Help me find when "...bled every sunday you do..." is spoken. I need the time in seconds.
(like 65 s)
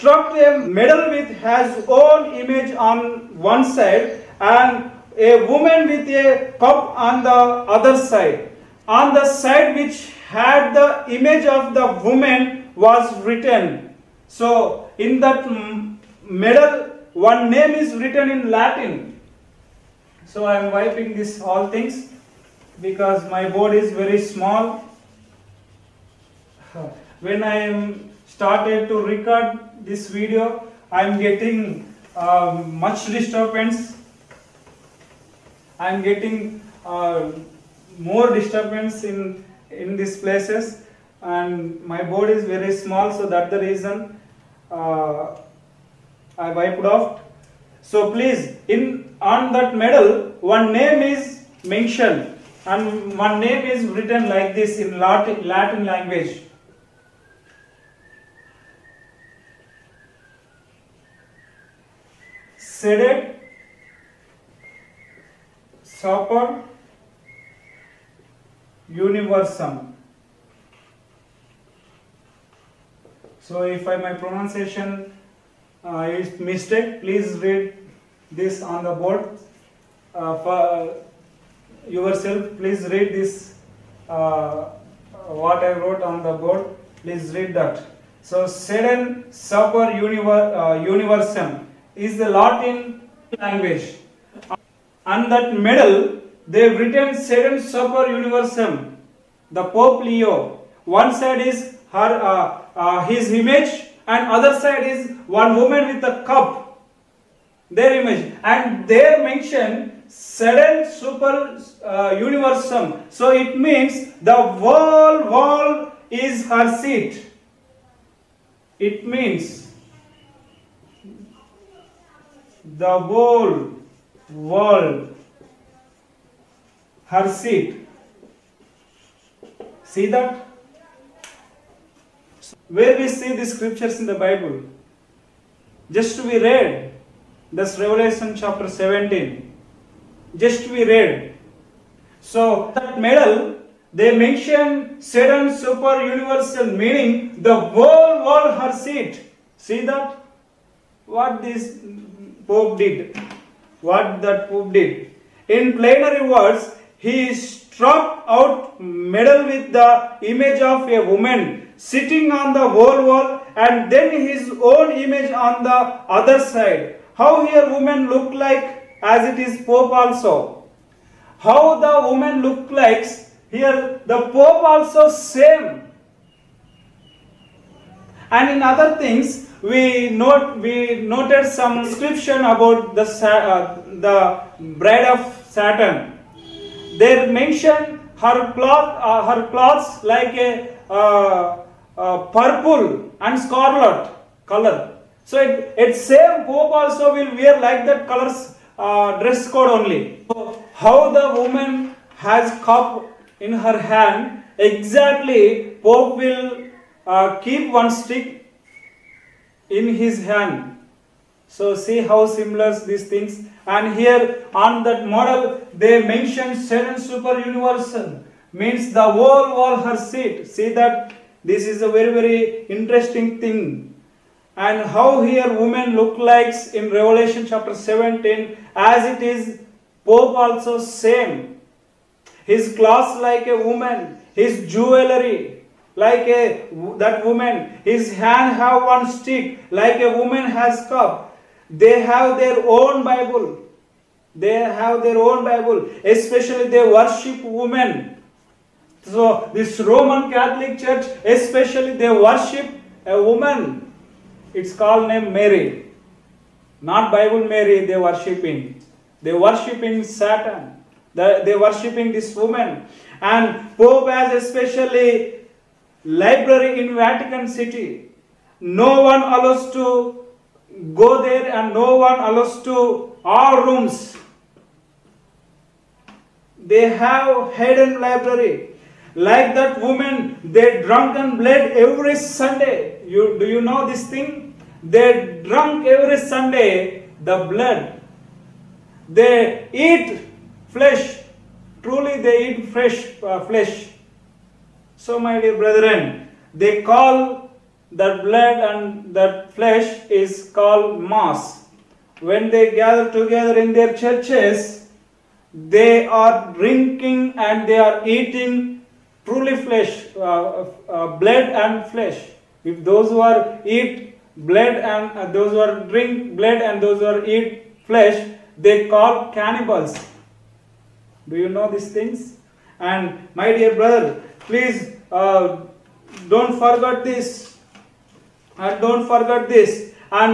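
281 s.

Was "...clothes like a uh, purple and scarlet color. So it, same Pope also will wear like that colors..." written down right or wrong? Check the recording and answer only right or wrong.
right.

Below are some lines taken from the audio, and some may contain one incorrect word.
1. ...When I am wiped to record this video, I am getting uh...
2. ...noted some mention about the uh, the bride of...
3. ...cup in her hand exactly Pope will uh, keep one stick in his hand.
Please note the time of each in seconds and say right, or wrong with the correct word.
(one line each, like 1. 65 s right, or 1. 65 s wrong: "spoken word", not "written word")
1. 27 s wrong: "started", not "wiped"
2. 181 s wrong: "description", not "mention"
3. 202 s right.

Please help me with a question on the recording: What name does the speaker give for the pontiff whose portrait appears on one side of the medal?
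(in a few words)
Pope Leo.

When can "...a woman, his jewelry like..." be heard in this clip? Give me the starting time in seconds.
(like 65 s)
233 s.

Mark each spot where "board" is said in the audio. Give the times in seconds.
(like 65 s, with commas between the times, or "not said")
23 s, 42 s, 79 s, 86 s.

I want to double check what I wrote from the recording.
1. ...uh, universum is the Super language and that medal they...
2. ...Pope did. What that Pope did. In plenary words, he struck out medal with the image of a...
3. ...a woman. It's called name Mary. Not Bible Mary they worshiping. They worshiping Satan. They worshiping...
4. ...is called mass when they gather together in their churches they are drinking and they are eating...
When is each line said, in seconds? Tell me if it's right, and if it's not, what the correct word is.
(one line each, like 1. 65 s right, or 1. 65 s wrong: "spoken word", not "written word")
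1. 90 s wrong: "Latin", not "Super"
2. 152 s right
3. 253 s right
4. 300 s right.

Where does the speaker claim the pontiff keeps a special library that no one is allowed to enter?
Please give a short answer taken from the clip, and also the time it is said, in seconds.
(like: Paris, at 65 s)
Vatican City, at 266 s.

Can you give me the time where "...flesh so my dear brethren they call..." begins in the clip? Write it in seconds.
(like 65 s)
293 s.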